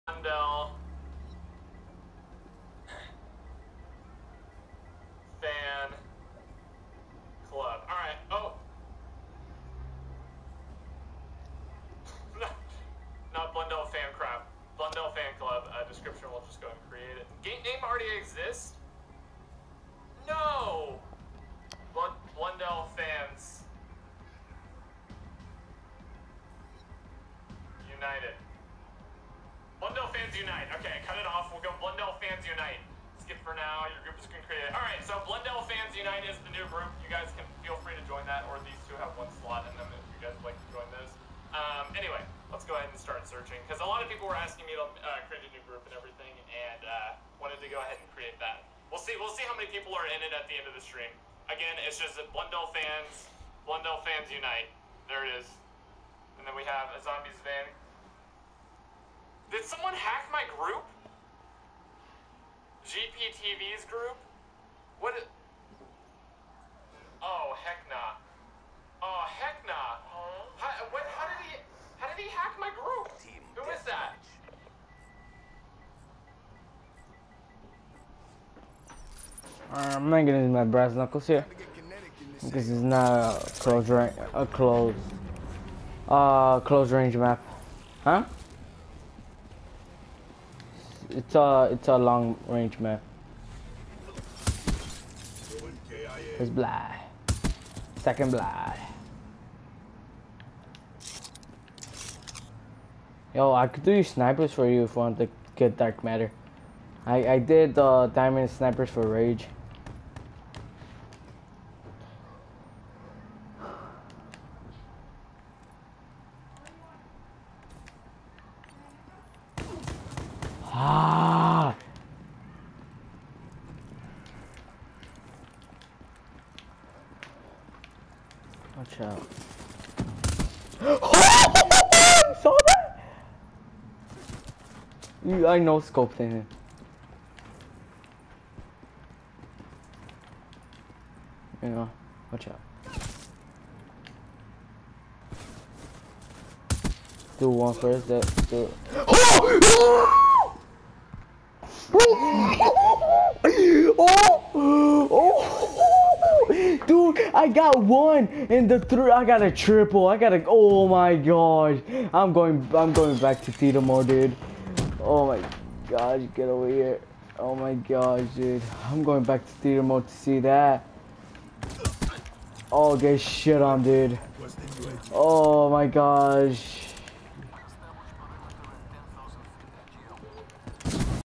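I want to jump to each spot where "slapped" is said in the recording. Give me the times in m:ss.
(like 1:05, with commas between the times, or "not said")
not said.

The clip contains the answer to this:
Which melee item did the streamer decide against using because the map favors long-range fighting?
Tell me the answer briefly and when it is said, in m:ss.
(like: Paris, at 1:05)
brass knuckles, at 1:20.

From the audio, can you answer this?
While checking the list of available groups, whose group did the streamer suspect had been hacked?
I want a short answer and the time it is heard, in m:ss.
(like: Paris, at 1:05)
GPTV, at 1:02.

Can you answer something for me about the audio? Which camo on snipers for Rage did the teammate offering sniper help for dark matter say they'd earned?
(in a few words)
diamond.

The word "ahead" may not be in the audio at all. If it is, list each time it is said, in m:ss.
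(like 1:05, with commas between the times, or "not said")
0:42, 0:47.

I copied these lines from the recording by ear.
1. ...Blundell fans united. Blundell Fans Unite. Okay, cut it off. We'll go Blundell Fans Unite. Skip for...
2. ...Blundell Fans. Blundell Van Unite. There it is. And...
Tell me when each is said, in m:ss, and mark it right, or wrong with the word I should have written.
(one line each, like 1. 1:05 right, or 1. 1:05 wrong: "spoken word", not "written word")
1. 0:22 right
2. 0:52 wrong: "Fans", not "Van".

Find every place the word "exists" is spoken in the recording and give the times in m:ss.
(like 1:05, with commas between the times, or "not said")
0:18.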